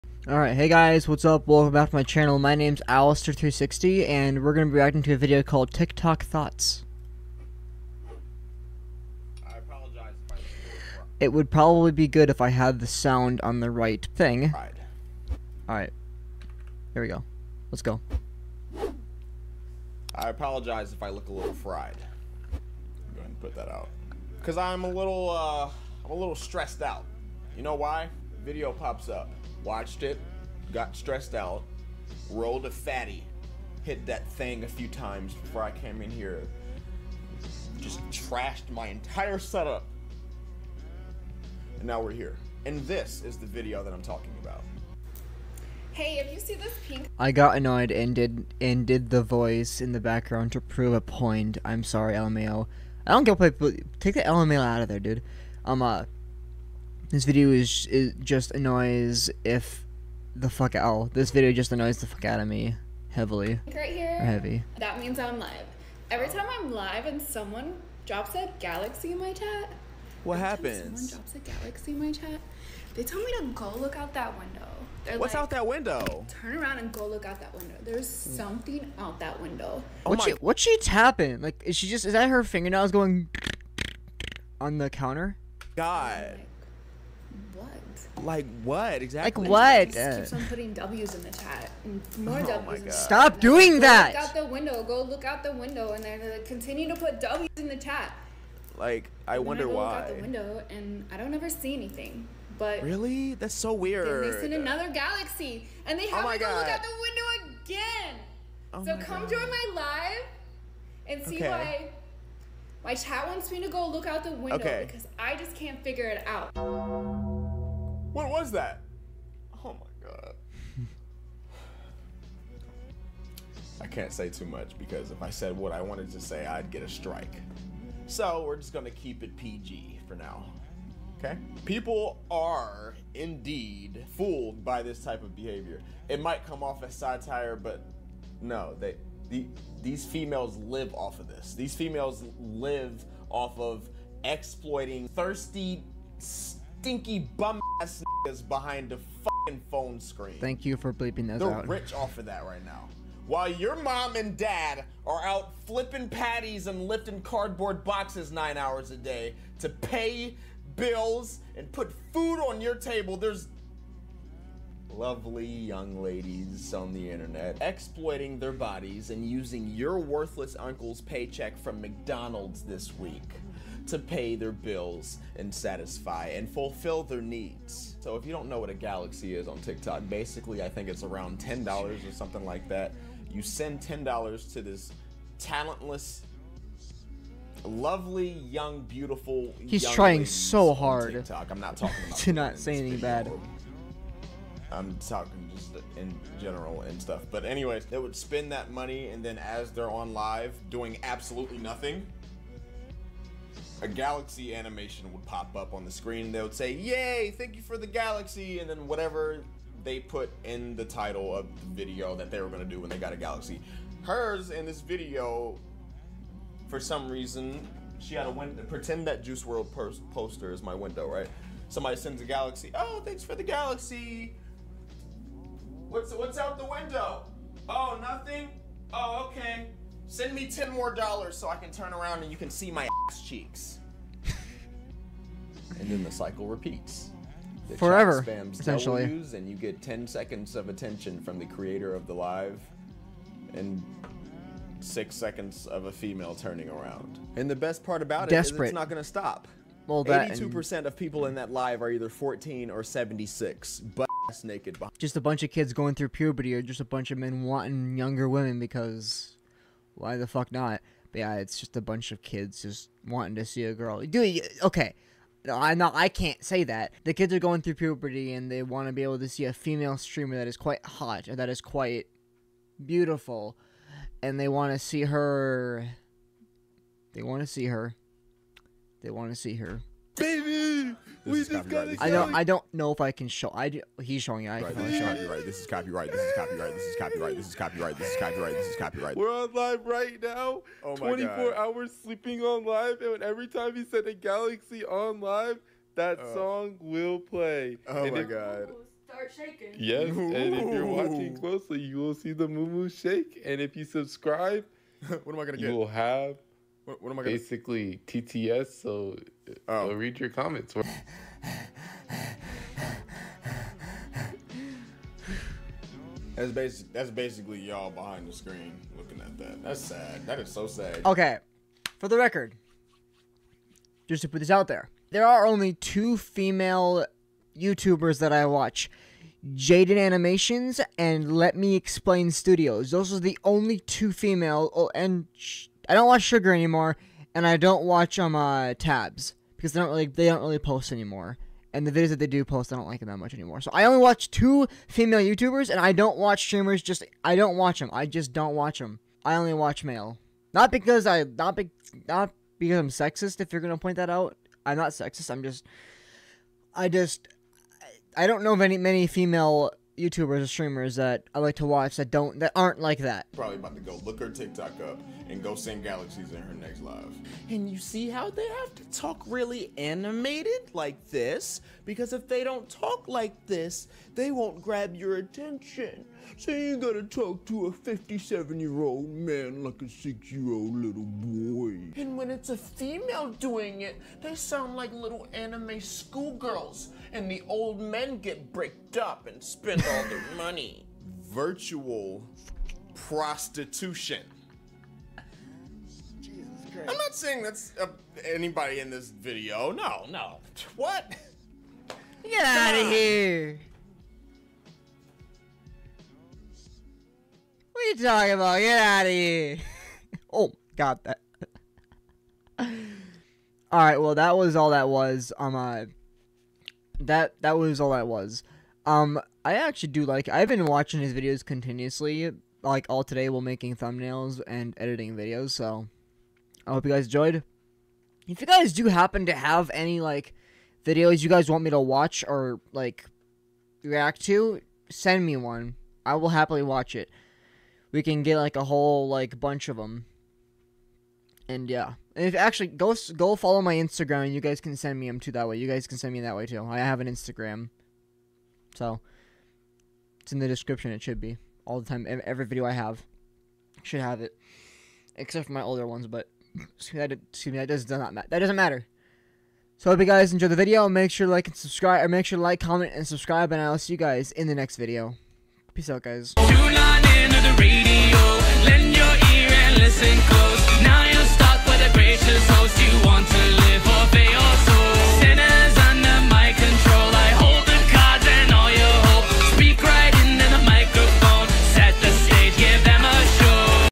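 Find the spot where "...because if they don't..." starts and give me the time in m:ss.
6:11.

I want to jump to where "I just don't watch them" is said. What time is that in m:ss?
5:47.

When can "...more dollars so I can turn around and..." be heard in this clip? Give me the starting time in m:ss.
3:50.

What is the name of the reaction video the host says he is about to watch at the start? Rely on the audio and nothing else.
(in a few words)
TikTok Thoughts.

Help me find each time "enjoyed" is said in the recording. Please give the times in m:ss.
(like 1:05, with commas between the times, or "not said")
7:07, 7:40.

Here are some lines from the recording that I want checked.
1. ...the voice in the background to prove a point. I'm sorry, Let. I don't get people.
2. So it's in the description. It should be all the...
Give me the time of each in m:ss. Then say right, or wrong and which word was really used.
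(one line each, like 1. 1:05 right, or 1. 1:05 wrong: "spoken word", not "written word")
1. 0:49 wrong: "LMAO", not "Let"
2. 7:28 right.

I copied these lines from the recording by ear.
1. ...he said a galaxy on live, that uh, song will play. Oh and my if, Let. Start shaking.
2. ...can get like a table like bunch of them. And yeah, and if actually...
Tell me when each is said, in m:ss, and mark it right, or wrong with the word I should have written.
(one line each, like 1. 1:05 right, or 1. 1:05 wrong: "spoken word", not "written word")
1. 4:53 wrong: "God", not "Let"
2. 7:18 wrong: "whole", not "table".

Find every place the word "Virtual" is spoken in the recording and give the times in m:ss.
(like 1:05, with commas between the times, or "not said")
6:31.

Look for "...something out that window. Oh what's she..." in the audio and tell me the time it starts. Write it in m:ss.
1:18.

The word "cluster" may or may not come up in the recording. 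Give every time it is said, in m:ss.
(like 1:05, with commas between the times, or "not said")
not said.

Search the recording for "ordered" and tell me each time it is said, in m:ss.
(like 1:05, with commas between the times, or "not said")
not said.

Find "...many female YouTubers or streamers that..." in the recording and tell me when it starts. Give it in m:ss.
5:58.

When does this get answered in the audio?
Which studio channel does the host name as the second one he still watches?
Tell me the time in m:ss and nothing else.
5:31.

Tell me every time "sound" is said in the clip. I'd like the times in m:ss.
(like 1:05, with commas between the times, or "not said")
0:12, 6:24.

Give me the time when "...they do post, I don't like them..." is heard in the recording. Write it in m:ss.
5:42.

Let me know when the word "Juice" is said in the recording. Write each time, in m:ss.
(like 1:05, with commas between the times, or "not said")
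3:39.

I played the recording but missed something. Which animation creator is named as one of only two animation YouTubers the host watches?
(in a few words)
Jaiden Animations.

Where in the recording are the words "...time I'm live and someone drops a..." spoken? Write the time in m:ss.
1:06.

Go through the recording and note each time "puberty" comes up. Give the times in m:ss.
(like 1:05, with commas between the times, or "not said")
4:16, 4:27.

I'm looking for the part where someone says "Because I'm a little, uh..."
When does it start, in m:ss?
0:24.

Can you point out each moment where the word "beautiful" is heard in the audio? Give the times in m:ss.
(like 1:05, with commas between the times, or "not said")
3:08, 4:32.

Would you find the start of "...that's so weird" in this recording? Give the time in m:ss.
1:43.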